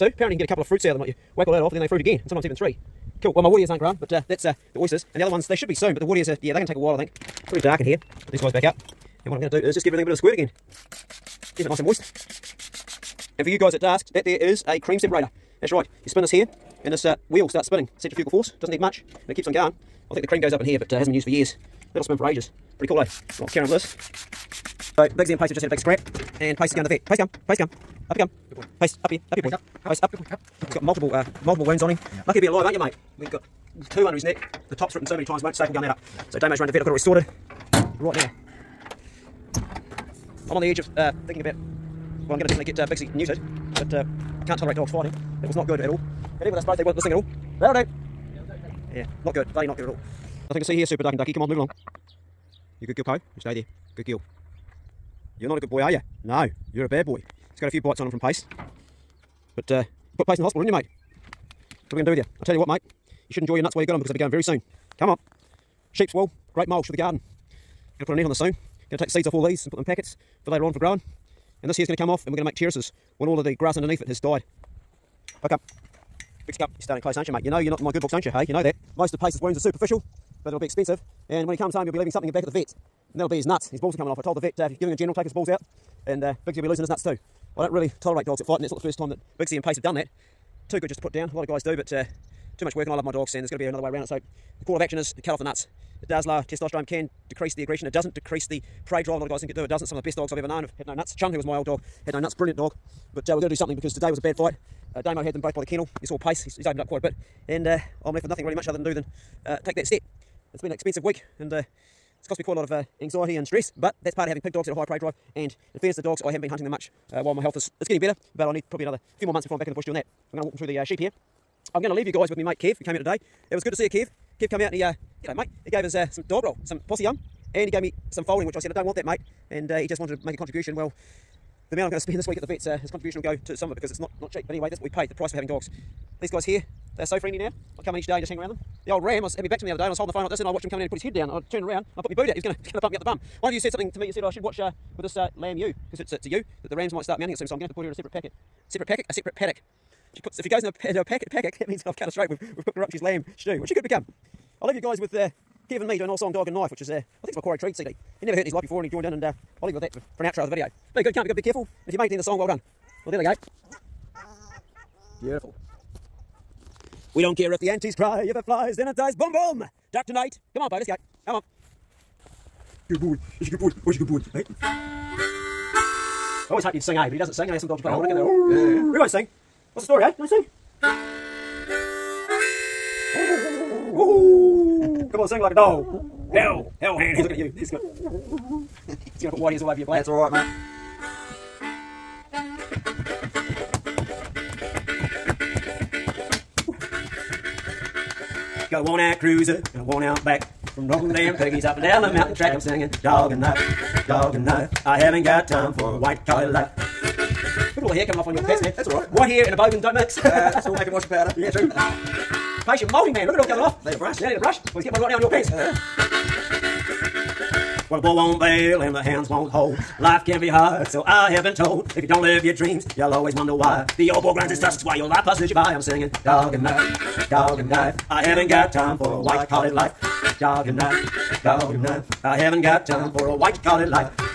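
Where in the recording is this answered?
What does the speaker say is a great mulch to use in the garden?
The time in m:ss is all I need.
1:05.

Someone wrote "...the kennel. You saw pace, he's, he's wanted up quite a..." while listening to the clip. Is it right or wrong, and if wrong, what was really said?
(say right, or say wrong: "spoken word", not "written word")
wrong: "opened", not "wanted".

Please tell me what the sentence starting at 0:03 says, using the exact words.
Cool, well my wood ears aren't grown, but uh, that's uh, the oysters.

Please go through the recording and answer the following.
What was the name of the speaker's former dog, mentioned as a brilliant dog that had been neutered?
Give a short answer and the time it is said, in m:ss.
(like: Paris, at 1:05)
Chun, at 1:41.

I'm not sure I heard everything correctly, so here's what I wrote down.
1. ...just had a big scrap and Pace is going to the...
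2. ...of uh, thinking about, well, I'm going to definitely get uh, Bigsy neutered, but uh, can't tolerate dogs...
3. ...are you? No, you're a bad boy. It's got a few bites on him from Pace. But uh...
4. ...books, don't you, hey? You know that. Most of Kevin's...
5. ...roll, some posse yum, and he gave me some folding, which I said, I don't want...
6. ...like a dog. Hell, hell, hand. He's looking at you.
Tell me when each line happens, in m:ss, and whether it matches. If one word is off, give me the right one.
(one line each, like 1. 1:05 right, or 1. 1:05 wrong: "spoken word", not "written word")
1. 0:25 right
2. 0:40 right
3. 0:55 right
4. 1:18 wrong: "Pace", not "Kevin"
5. 2:06 right
6. 3:05 right.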